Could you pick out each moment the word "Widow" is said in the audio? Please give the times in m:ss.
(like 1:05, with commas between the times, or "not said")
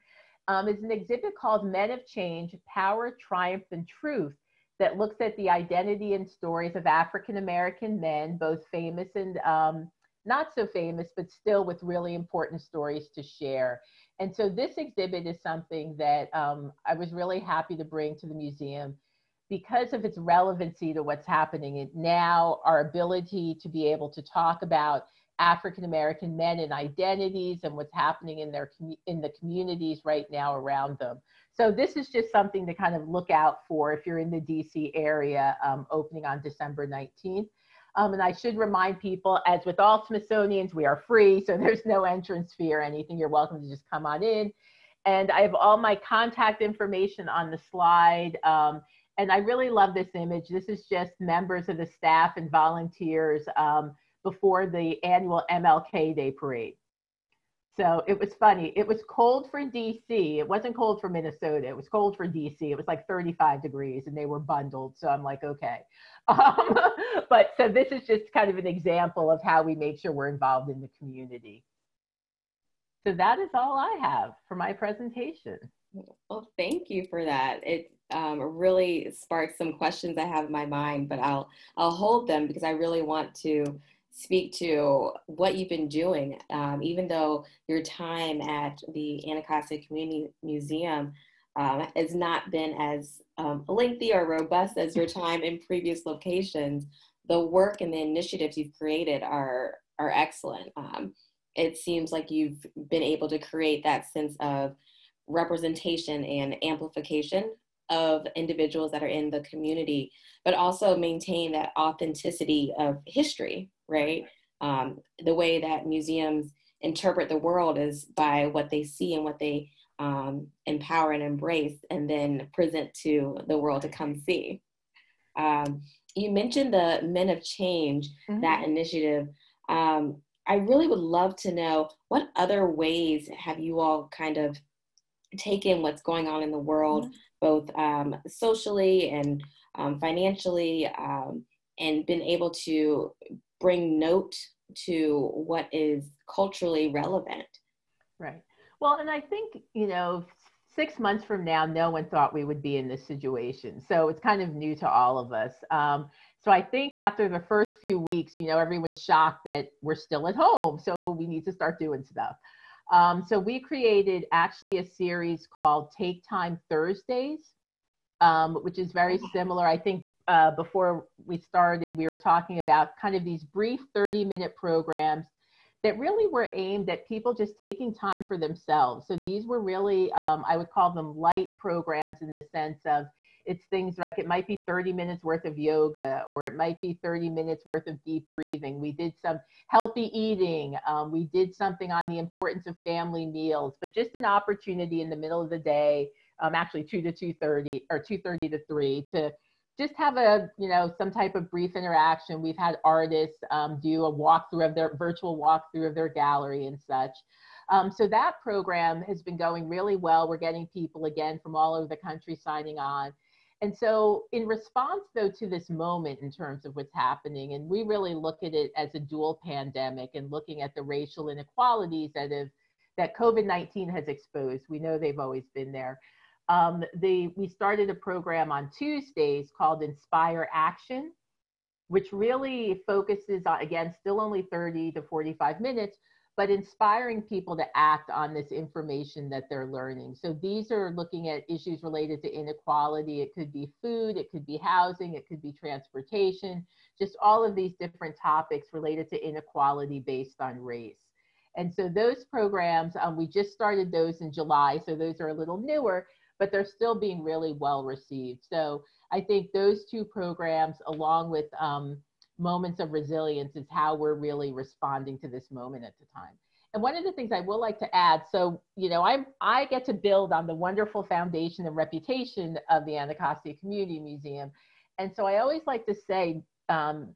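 not said.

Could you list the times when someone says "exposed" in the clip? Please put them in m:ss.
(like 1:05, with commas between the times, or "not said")
3:44.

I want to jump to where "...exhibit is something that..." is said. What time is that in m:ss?
0:14.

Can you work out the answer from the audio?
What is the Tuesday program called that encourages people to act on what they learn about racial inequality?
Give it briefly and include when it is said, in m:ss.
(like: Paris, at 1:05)
Inspire Action, at 3:49.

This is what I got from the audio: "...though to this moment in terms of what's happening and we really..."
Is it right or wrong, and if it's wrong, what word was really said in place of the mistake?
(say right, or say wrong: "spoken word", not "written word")
right.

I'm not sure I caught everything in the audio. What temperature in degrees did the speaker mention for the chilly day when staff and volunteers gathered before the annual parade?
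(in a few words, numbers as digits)
35.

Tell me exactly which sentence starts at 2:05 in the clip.
Um, you mentioned the Men of Change, mm-hmm.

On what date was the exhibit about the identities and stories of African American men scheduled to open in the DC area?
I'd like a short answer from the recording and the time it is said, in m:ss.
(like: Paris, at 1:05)
December 19, at 0:36.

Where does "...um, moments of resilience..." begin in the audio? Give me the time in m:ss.
4:21.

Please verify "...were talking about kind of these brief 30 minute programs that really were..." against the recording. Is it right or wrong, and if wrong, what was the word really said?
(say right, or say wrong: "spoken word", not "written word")
right.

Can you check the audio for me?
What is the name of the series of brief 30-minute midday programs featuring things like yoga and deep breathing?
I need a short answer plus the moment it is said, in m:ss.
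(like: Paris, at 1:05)
Take Time Thursdays, at 2:45.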